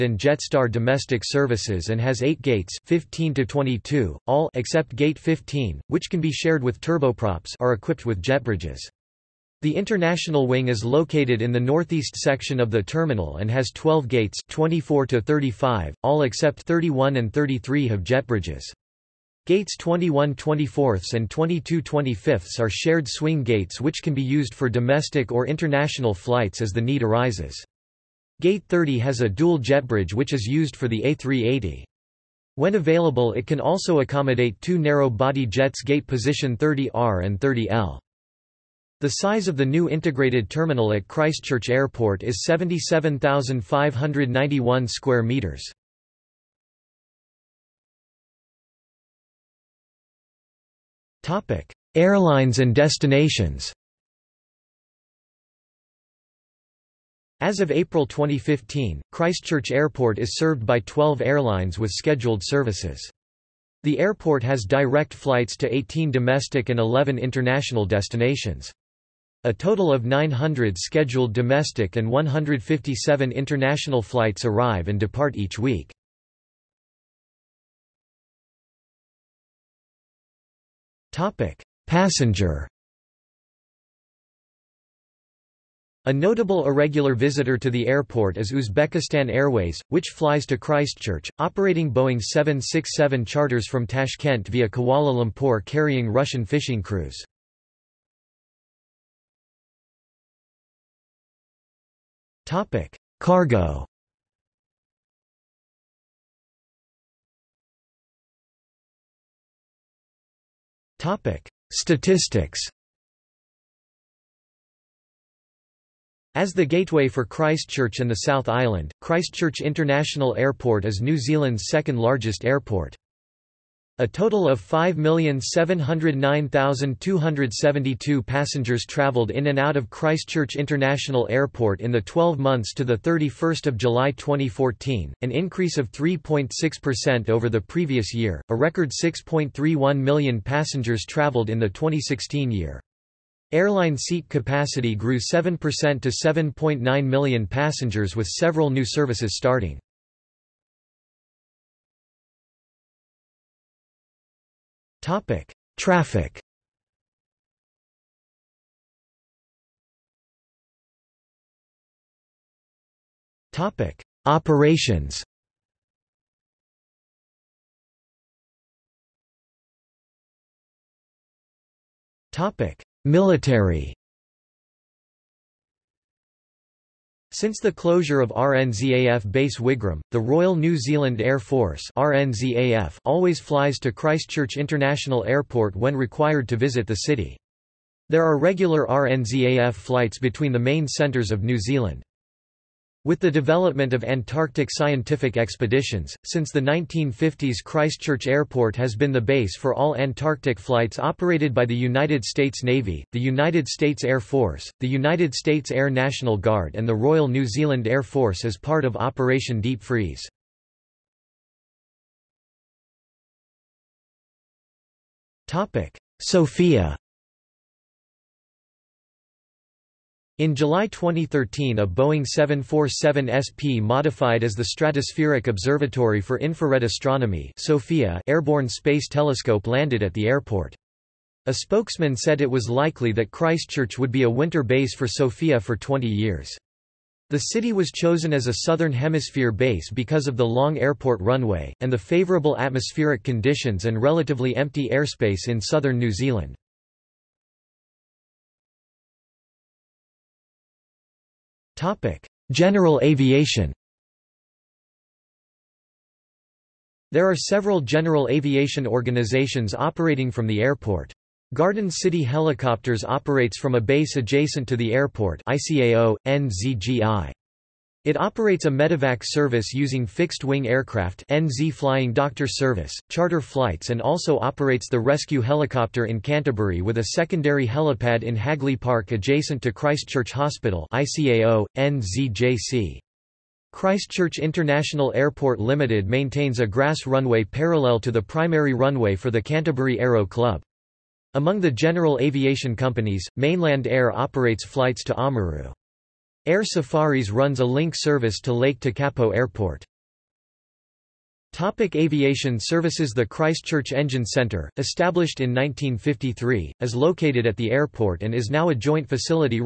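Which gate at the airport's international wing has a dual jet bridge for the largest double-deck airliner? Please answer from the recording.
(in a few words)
30.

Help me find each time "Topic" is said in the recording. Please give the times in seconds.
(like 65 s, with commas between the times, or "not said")
81 s, 111 s, 155 s, 163 s, 172 s, 301 s.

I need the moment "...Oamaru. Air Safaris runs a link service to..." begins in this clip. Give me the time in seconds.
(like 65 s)
295 s.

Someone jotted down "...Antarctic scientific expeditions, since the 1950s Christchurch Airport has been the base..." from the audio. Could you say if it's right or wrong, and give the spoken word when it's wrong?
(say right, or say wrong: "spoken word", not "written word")
right.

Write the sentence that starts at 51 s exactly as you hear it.
Airlines and destinations As of April 2015, Christchurch Airport is served by 12 airlines with scheduled services.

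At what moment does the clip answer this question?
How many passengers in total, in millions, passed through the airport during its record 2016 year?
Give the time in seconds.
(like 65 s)
139 s.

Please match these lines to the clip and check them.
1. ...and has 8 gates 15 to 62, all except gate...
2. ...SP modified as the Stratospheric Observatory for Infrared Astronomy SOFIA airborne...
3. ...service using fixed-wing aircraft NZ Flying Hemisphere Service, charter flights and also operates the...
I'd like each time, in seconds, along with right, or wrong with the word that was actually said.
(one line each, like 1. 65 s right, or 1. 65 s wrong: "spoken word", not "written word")
1. 1 s wrong: "22", not "62"
2. 223 s right
3. 269 s wrong: "Doctor", not "Hemisphere".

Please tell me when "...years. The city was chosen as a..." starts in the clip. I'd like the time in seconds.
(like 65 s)
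236 s.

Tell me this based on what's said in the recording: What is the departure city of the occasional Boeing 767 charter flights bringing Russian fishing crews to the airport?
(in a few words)
Tashkent.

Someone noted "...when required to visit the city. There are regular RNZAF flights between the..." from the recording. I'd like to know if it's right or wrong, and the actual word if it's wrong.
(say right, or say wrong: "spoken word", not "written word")
right.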